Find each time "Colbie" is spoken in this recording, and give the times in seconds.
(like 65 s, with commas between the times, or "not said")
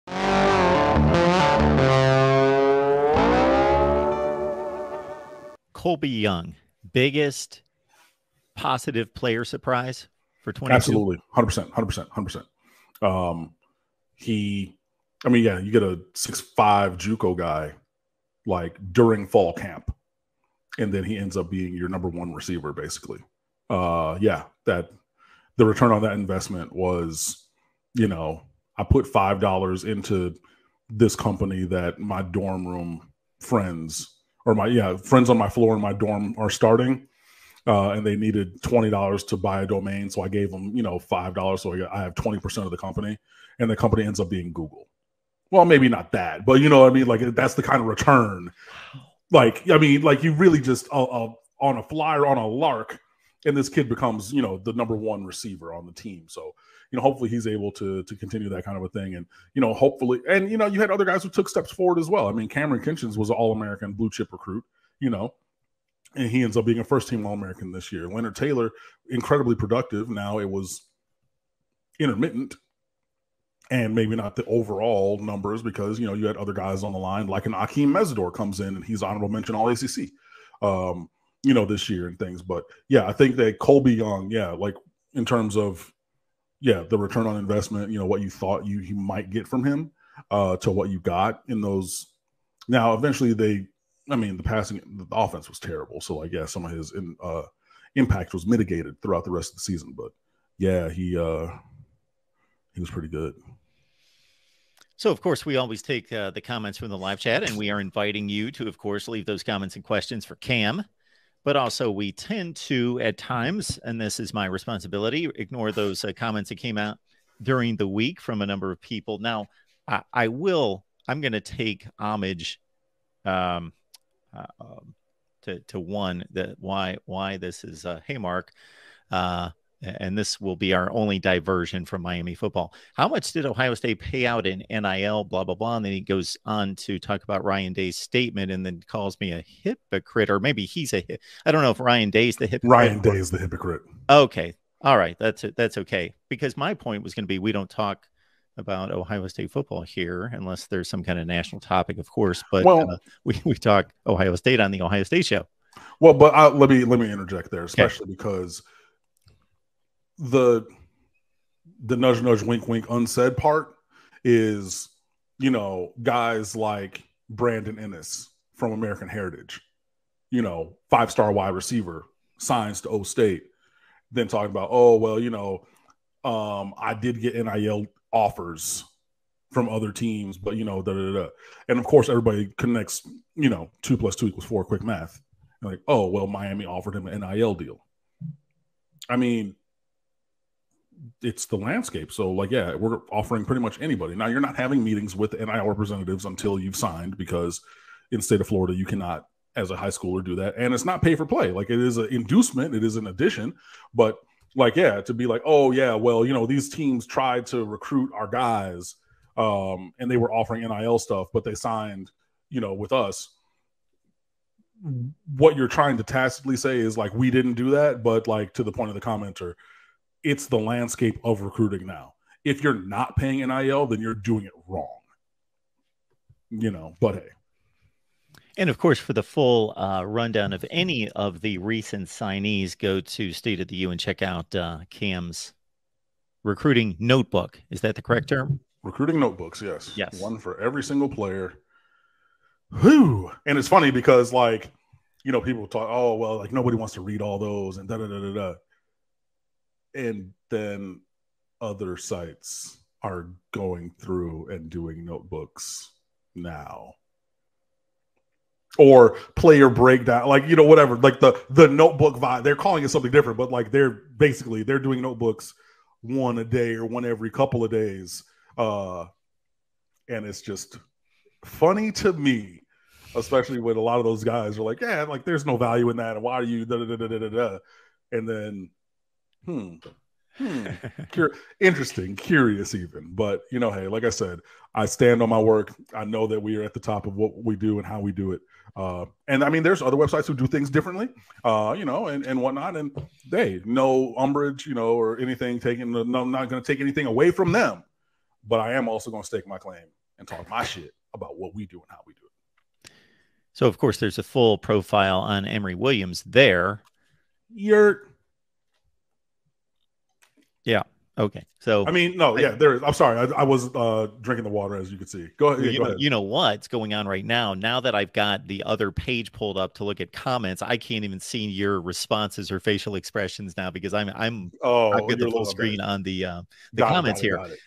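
5 s, 83 s.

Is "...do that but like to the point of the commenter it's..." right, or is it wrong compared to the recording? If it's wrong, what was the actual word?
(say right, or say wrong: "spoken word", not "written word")
right.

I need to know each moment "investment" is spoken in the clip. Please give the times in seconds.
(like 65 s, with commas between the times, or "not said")
26 s, 87 s.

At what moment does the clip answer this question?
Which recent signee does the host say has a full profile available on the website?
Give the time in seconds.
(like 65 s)
305 s.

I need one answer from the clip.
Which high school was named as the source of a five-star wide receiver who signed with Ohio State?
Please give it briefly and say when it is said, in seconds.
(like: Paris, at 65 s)
American Heritage, at 168 s.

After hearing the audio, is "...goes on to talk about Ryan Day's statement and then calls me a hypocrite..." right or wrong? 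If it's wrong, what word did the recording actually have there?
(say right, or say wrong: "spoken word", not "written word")
right.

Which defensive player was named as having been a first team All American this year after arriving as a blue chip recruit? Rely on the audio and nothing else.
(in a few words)
Kamren Kinchens.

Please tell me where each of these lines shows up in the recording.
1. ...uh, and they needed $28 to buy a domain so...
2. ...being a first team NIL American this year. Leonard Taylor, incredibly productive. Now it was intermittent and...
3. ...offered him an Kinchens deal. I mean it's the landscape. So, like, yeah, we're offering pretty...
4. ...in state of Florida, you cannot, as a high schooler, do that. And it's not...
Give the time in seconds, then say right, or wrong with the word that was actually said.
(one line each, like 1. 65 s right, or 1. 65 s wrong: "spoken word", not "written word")
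1. 37 s wrong: "20", not "28"
2. 66 s wrong: "All", not "NIL"
3. 186 s wrong: "NIL", not "Kinchens"
4. 198 s right.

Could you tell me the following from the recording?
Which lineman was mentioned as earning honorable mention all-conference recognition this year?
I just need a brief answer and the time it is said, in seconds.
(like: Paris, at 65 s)
Akeem Mesidor, at 77 s.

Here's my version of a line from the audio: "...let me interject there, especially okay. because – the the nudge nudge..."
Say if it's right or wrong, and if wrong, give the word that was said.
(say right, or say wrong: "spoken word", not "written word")
right.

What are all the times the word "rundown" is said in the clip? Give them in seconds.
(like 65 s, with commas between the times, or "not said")
230 s.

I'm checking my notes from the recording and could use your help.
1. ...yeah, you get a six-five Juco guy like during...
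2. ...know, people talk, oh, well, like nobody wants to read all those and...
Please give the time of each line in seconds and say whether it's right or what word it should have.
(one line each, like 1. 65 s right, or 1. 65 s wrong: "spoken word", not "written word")
1. 15 s right
2. 245 s right.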